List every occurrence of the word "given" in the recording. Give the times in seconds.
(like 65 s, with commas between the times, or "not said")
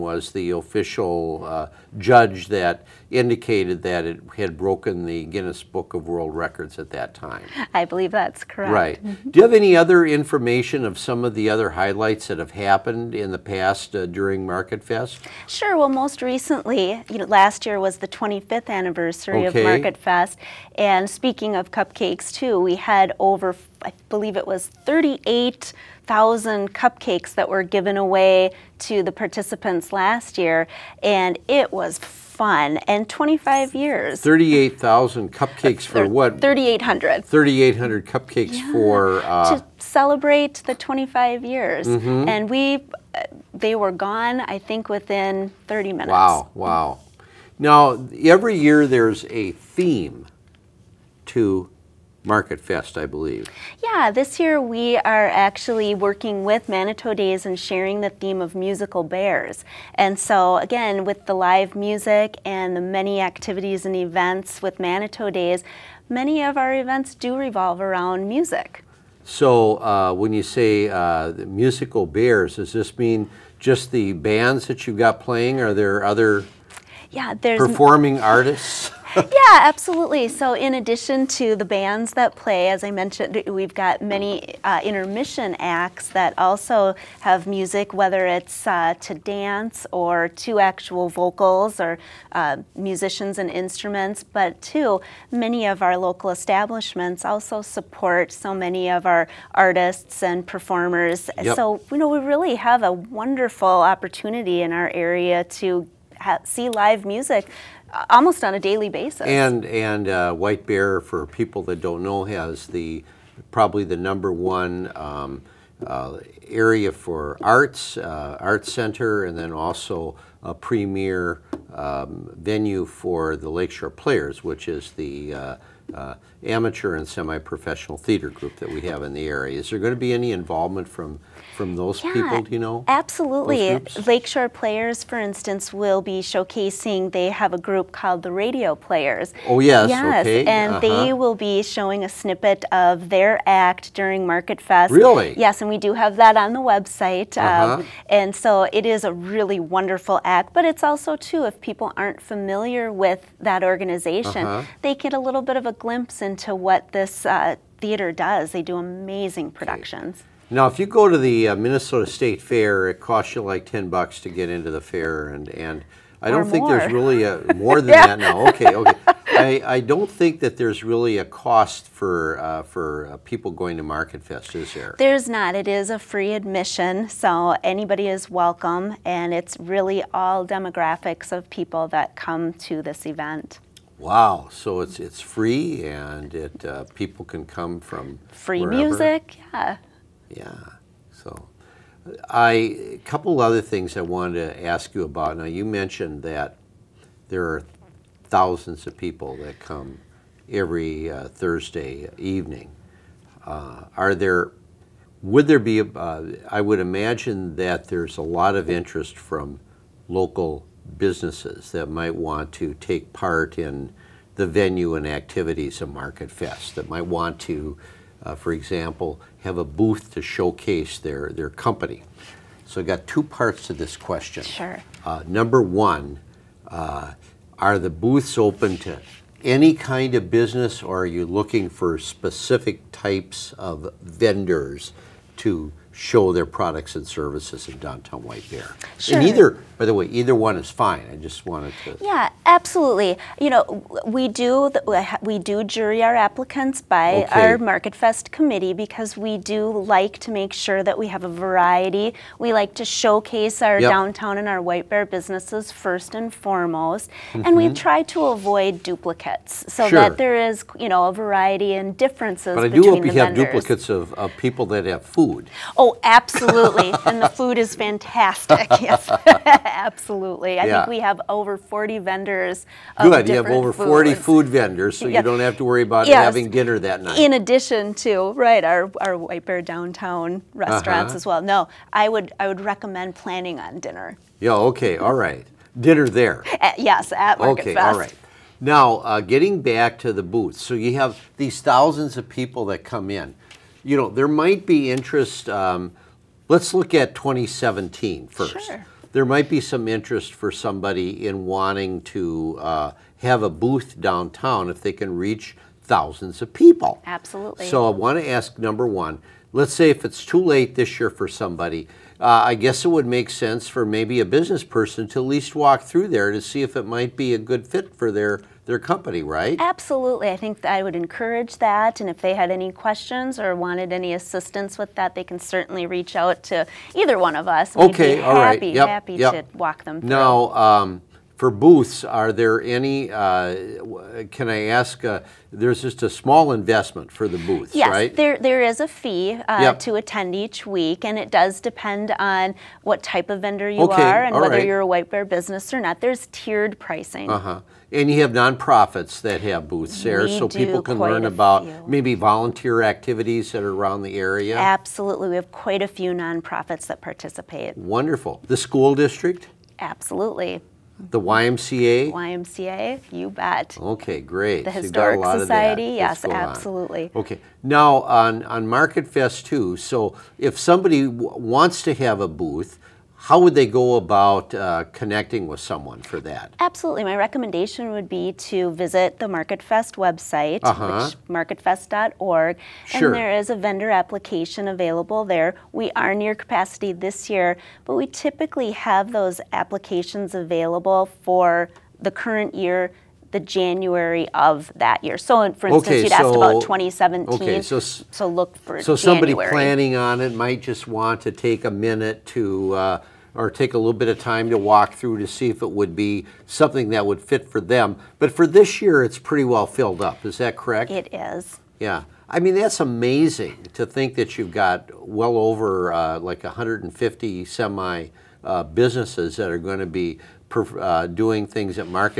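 27 s.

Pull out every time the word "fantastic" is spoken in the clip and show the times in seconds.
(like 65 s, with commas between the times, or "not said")
267 s.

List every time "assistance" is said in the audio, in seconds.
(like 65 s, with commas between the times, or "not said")
324 s.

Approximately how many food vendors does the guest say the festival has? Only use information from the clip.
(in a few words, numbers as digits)
over 40.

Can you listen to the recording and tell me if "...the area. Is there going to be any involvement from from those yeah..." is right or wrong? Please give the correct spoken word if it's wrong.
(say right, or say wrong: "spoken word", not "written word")
right.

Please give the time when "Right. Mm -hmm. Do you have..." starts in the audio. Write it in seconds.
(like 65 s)
8 s.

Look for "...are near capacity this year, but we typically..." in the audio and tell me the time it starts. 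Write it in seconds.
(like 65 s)
386 s.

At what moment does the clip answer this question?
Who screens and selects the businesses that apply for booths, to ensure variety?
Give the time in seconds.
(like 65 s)
247 s.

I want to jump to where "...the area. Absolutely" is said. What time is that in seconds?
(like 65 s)
354 s.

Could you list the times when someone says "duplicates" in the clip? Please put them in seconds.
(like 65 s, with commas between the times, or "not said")
258 s, 263 s.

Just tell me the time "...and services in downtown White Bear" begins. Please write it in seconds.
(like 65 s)
236 s.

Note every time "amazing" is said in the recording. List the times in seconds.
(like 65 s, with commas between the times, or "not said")
158 s, 412 s.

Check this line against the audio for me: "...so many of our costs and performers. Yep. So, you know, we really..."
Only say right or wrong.
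wrong.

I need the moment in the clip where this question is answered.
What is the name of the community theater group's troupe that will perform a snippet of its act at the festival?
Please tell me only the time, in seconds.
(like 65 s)
138 s.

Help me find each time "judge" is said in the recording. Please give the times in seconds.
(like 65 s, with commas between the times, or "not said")
1 s.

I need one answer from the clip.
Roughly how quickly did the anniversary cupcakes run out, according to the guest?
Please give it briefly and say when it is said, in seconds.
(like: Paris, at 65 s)
30 minutes, at 44 s.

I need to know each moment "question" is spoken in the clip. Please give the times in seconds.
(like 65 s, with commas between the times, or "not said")
223 s, 322 s.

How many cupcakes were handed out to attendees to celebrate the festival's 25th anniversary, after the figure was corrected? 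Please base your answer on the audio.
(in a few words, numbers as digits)
3,800.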